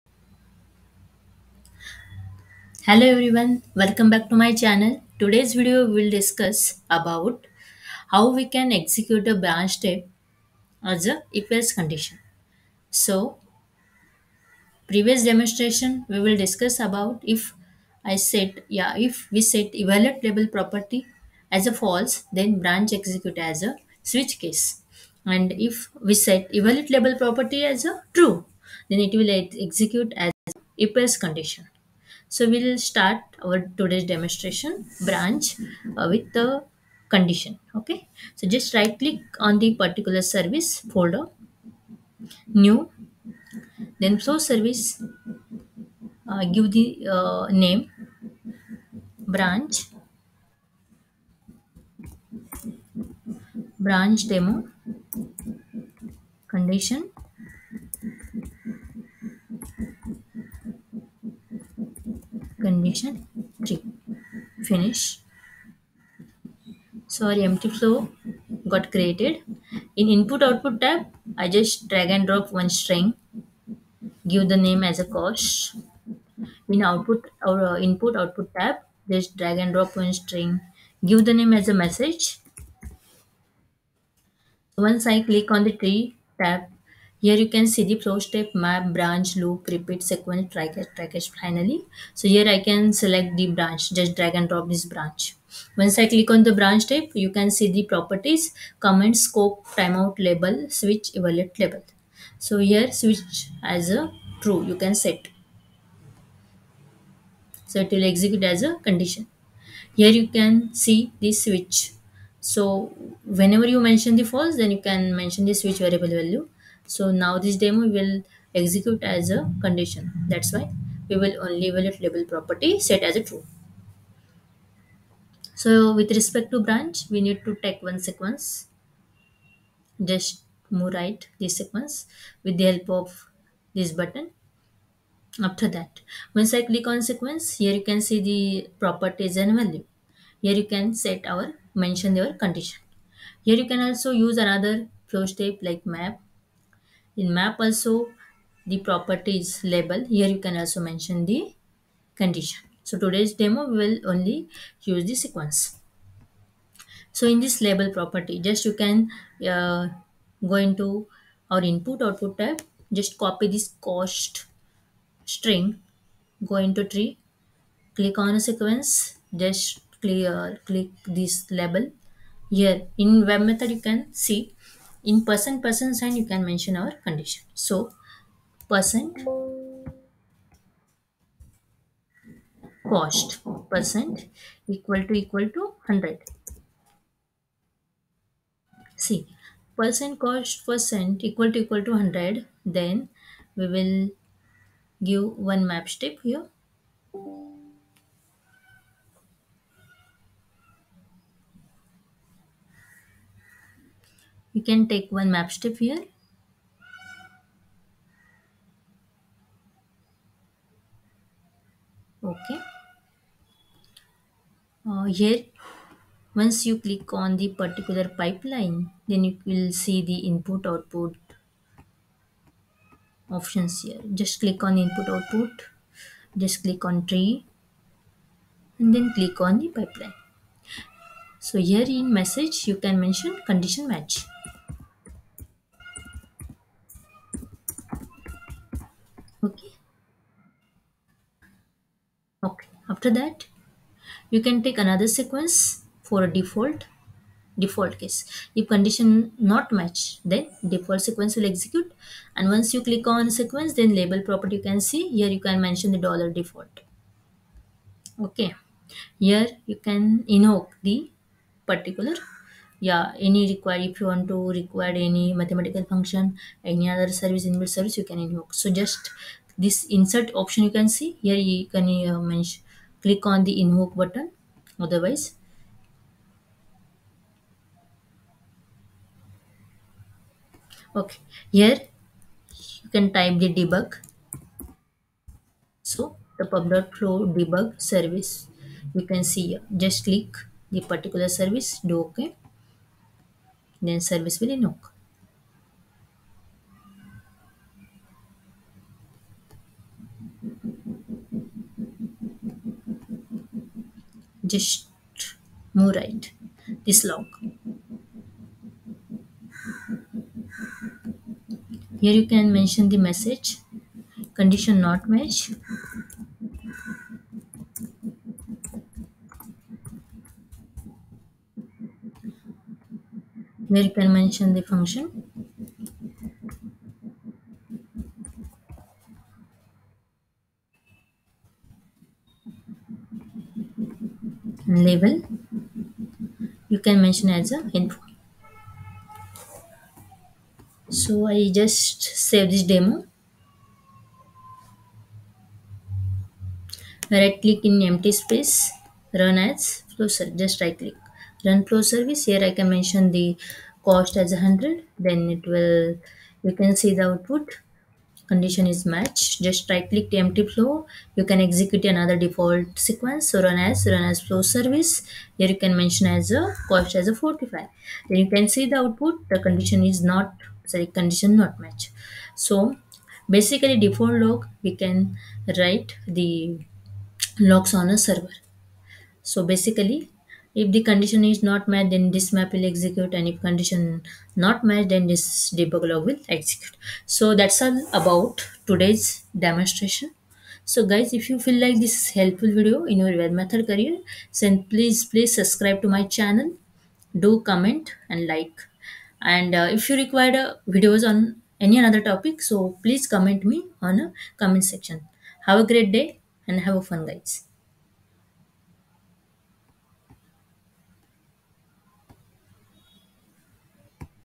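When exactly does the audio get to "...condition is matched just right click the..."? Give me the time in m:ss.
5:58.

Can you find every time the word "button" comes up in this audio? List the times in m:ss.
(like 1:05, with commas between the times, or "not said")
2:13, 4:33.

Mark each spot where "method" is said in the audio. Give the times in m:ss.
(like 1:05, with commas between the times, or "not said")
2:53, 6:33.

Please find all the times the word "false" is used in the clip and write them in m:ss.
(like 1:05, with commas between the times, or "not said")
0:21, 1:54.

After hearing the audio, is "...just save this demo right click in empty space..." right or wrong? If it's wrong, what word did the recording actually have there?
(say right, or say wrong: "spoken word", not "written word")
right.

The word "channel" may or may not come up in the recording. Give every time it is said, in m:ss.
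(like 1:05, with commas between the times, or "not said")
0:04, 6:36.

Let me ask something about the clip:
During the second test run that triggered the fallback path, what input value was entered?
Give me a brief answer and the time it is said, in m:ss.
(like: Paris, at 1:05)
45, at 6:07.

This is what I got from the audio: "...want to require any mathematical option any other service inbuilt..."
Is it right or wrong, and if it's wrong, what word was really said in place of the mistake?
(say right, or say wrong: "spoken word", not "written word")
wrong: "function", not "option".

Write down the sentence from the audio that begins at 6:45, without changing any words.
Have a great day and have a fun guys.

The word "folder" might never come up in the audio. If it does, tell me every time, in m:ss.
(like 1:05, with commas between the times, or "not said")
0:40.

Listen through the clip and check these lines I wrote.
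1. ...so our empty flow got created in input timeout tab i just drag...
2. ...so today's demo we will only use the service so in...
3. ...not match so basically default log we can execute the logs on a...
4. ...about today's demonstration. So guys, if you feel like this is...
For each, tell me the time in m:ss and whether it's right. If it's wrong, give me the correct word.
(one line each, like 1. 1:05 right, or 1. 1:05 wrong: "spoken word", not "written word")
1. 1:07 wrong: "output", not "timeout"
2. 2:32 wrong: "sequence", not "service"
3. 6:11 wrong: "write", not "execute"
4. 6:27 right.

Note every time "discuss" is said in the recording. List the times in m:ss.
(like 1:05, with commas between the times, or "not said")
0:06, 0:16.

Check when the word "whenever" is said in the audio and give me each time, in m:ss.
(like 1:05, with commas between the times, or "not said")
1:53.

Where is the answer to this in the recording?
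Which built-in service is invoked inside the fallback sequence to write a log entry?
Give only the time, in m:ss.
4:46.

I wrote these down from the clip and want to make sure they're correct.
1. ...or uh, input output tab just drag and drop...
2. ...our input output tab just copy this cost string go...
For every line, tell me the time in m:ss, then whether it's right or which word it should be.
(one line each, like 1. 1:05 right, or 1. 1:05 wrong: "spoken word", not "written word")
1. 1:17 right
2. 2:41 right.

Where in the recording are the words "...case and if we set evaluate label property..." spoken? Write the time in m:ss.
0:24.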